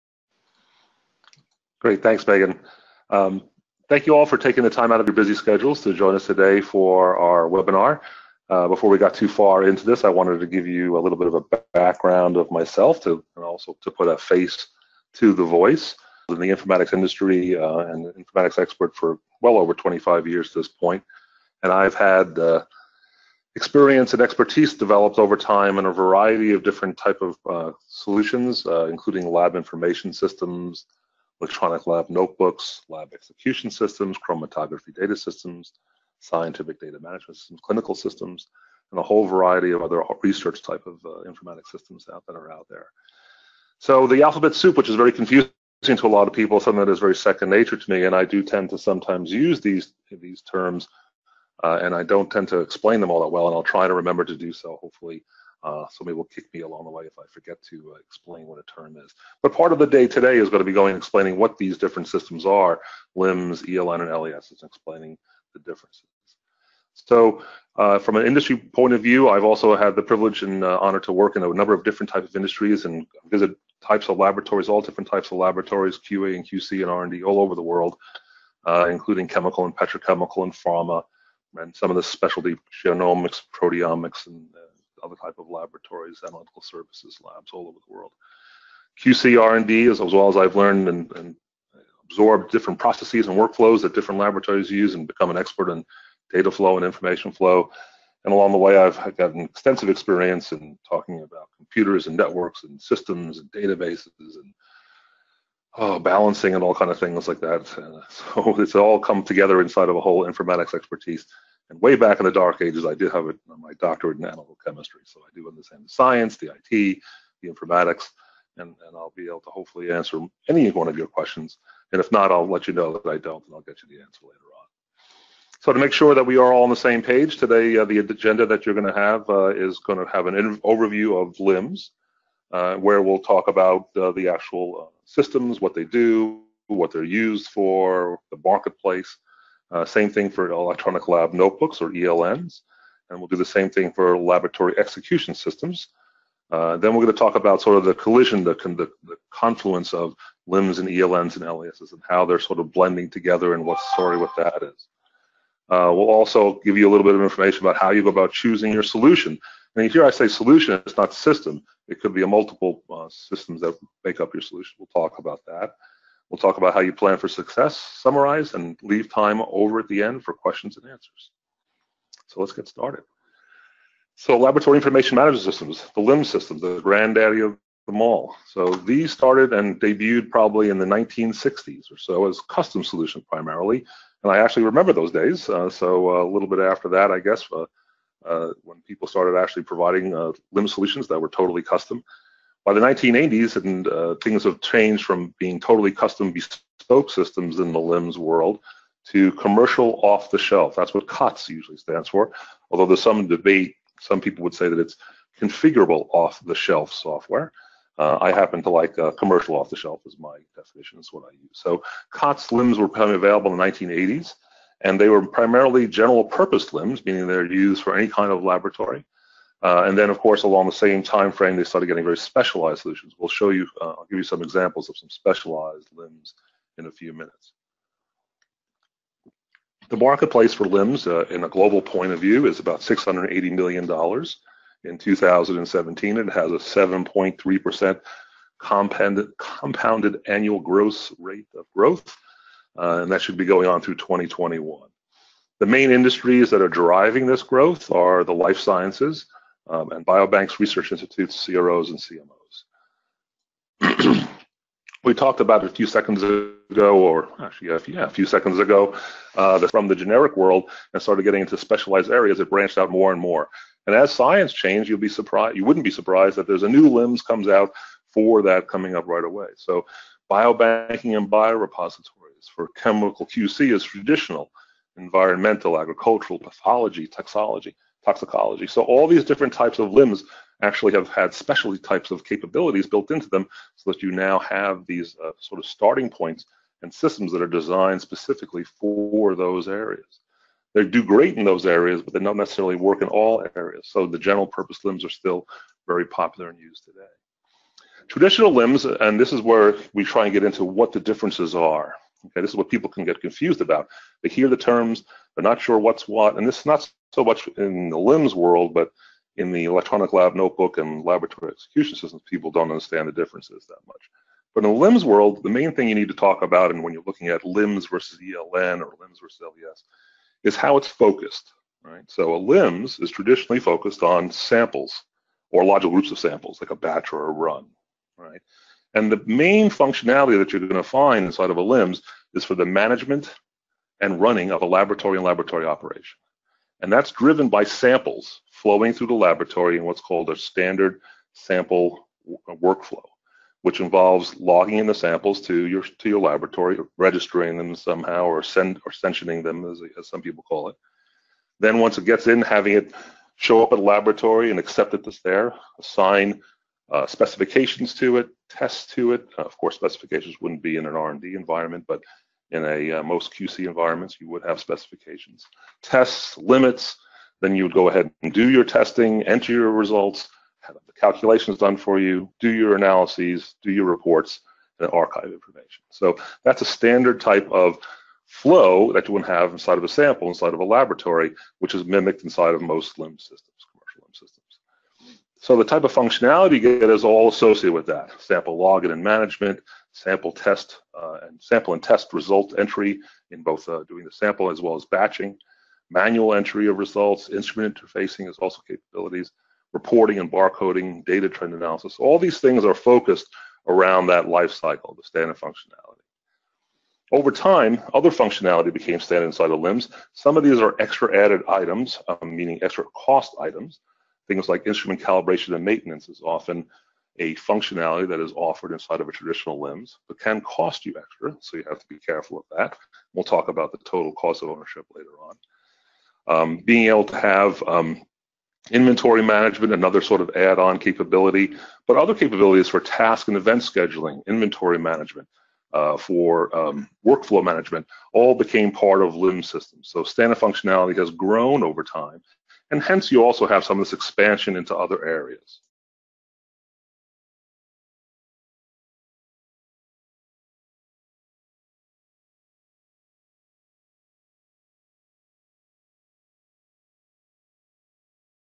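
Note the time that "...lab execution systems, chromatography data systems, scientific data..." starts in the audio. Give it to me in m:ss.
0:32.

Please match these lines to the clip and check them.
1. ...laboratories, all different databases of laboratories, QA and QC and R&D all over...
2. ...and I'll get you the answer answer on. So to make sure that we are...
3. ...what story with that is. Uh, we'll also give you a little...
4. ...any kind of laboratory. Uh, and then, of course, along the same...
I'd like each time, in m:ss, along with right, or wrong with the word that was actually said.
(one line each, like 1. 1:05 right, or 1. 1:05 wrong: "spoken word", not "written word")
1. 1:14 wrong: "types", not "databases"
2. 2:03 wrong: "later", not "answer"
3. 2:33 right
4. 3:37 right.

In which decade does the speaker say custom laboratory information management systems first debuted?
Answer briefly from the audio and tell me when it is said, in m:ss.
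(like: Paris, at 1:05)
1960s, at 3:00.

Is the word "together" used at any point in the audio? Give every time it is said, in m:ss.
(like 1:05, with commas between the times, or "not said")
1:49, 2:33.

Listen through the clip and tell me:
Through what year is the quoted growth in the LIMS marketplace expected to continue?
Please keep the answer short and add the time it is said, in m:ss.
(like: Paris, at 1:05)
2021, at 4:03.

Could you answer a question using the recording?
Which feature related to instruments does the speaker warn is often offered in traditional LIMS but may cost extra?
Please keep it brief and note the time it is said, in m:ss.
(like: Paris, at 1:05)
instrument calibration and maintenance, at 6:54.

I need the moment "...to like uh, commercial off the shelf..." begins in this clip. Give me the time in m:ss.
3:28.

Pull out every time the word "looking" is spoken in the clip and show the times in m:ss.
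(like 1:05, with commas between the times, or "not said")
5:17.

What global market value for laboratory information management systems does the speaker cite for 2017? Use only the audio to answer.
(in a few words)
$680 million.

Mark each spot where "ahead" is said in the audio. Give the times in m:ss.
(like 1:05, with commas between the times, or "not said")
6:07.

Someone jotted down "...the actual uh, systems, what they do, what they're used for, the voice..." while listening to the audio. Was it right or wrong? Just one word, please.
wrong.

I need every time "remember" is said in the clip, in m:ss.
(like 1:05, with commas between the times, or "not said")
0:53, 3:04.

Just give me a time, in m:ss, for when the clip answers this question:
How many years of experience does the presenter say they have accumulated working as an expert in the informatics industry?
0:19.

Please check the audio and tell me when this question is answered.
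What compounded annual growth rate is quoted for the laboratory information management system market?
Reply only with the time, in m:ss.
3:56.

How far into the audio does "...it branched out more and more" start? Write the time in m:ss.
4:22.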